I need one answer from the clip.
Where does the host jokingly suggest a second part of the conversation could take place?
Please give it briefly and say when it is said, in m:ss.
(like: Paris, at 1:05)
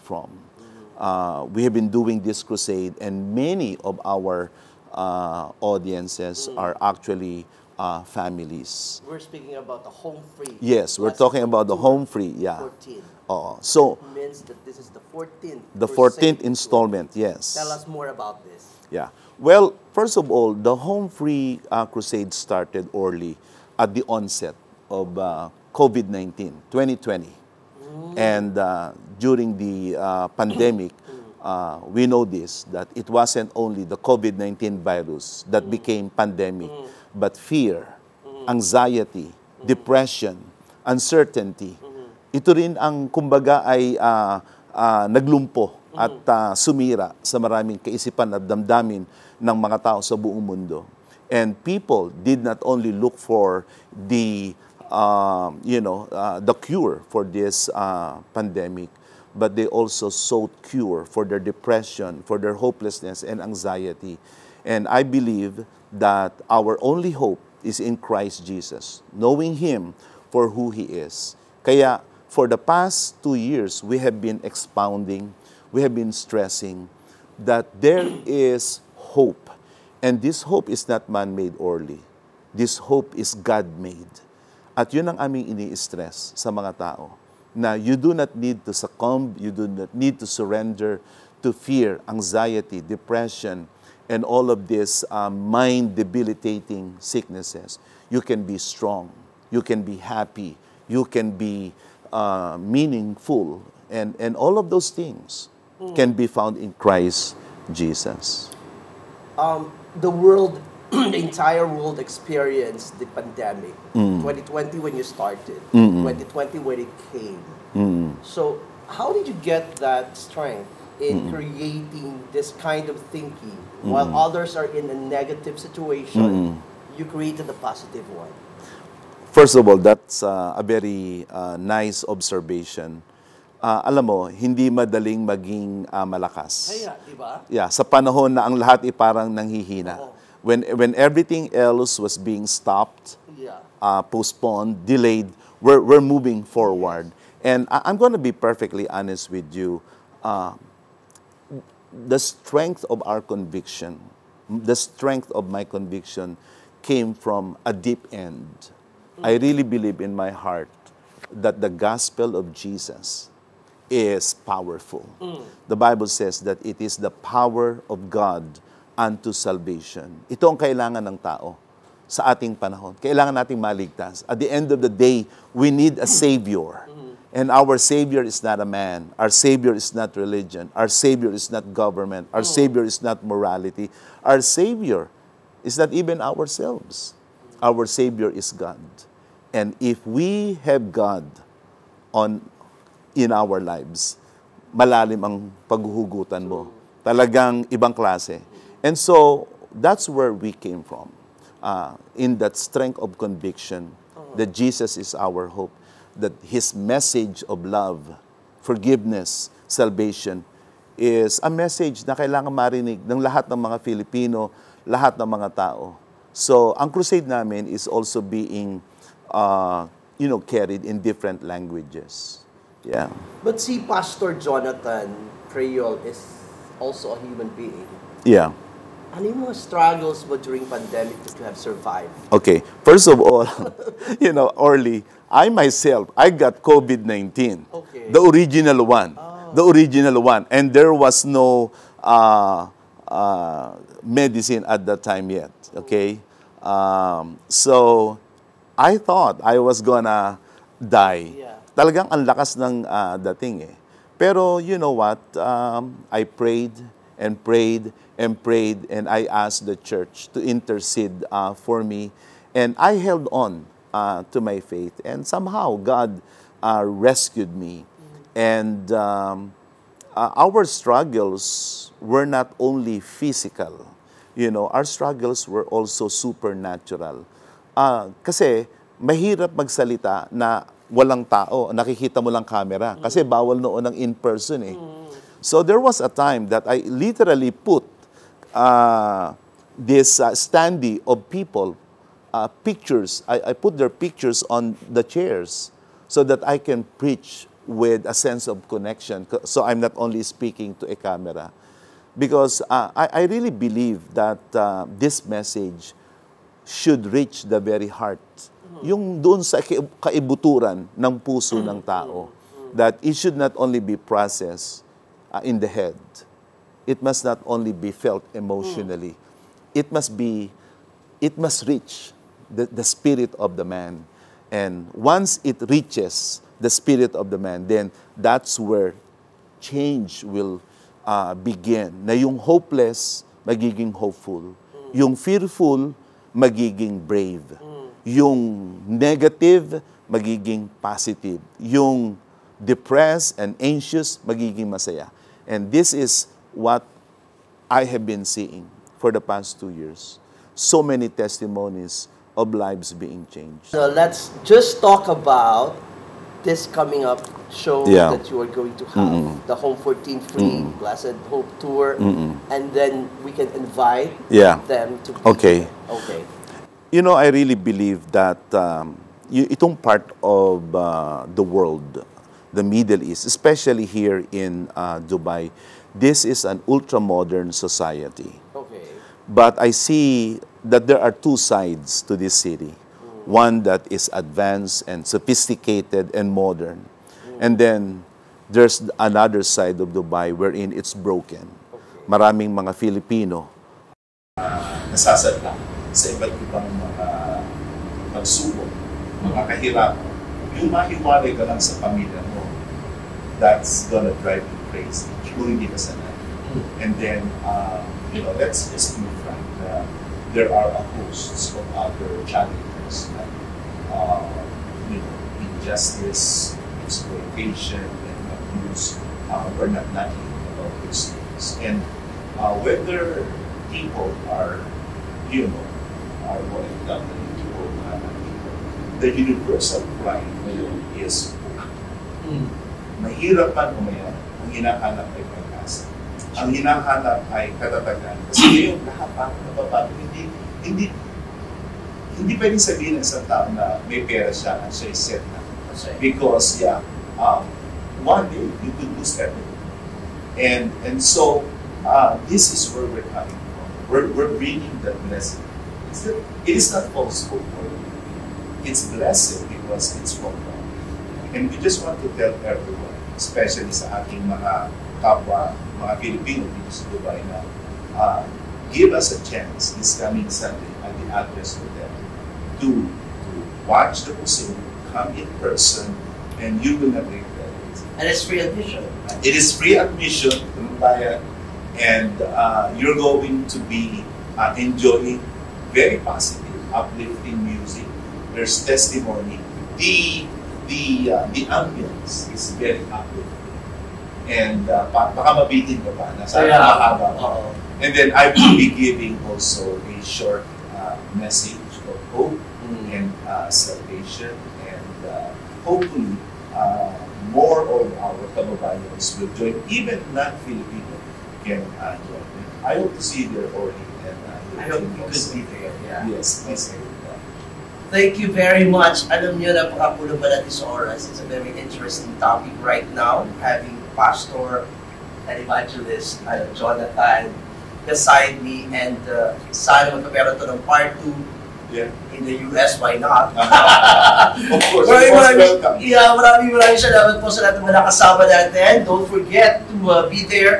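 the US, at 8:52.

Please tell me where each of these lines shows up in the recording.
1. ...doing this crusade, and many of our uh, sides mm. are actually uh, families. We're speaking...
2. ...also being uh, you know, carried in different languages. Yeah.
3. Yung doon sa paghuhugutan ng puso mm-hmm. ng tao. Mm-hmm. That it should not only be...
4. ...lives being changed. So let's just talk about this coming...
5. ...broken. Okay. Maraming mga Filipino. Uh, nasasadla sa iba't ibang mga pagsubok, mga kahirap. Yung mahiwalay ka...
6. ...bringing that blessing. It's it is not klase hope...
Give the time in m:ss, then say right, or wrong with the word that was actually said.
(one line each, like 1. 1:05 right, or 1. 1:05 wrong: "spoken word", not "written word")
1. 0:01 wrong: "audiences", not "sides"
2. 3:37 right
3. 5:08 wrong: "kaibuturan", not "paghuhugutan"
4. 5:52 right
5. 6:30 right
6. 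7:34 wrong: "false", not "klase".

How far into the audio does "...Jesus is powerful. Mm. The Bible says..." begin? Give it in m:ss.
2:42.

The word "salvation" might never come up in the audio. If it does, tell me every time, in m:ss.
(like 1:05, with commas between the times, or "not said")
2:49, 3:29, 8:23.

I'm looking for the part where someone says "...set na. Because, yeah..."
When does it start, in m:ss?
7:24.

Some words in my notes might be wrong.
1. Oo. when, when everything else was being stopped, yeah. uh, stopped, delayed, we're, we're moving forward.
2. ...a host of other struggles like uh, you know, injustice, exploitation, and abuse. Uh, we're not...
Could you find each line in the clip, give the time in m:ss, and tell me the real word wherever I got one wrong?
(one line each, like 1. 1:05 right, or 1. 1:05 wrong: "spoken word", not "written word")
1. 2:20 wrong: "postponed", not "stopped"
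2. 6:50 wrong: "challenges", not "struggles".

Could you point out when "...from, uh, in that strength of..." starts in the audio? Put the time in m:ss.
3:20.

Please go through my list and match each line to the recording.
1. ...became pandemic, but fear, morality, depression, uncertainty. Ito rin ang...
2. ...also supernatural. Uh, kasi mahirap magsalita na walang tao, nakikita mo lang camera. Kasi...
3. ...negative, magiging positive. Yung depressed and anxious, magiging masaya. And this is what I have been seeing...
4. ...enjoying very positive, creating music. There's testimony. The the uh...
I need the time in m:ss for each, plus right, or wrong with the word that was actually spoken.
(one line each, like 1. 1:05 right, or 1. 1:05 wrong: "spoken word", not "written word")
1. 0:35 wrong: "anxiety", not "morality"
2. 4:35 right
3. 5:38 right
4. 8:04 wrong: "uplifting", not "creating".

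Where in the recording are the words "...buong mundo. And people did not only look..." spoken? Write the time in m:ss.
0:50.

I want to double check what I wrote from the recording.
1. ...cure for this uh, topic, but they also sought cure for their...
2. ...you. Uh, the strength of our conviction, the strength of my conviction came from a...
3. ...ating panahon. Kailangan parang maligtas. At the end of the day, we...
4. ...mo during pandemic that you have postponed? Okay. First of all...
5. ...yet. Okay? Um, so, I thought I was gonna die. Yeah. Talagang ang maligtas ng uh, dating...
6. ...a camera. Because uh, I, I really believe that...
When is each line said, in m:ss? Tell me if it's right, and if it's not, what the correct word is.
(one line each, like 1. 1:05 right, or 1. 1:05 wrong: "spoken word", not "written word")
1. 0:56 wrong: "pandemic", not "topic"
2. 2:29 right
3. 2:52 wrong: "nating", not "parang"
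4. 3:50 wrong: "survived", not "postponed"
5. 4:05 wrong: "lakas", not "maligtas"
6. 5:00 right.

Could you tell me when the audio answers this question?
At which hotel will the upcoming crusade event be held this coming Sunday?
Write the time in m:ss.
7:51.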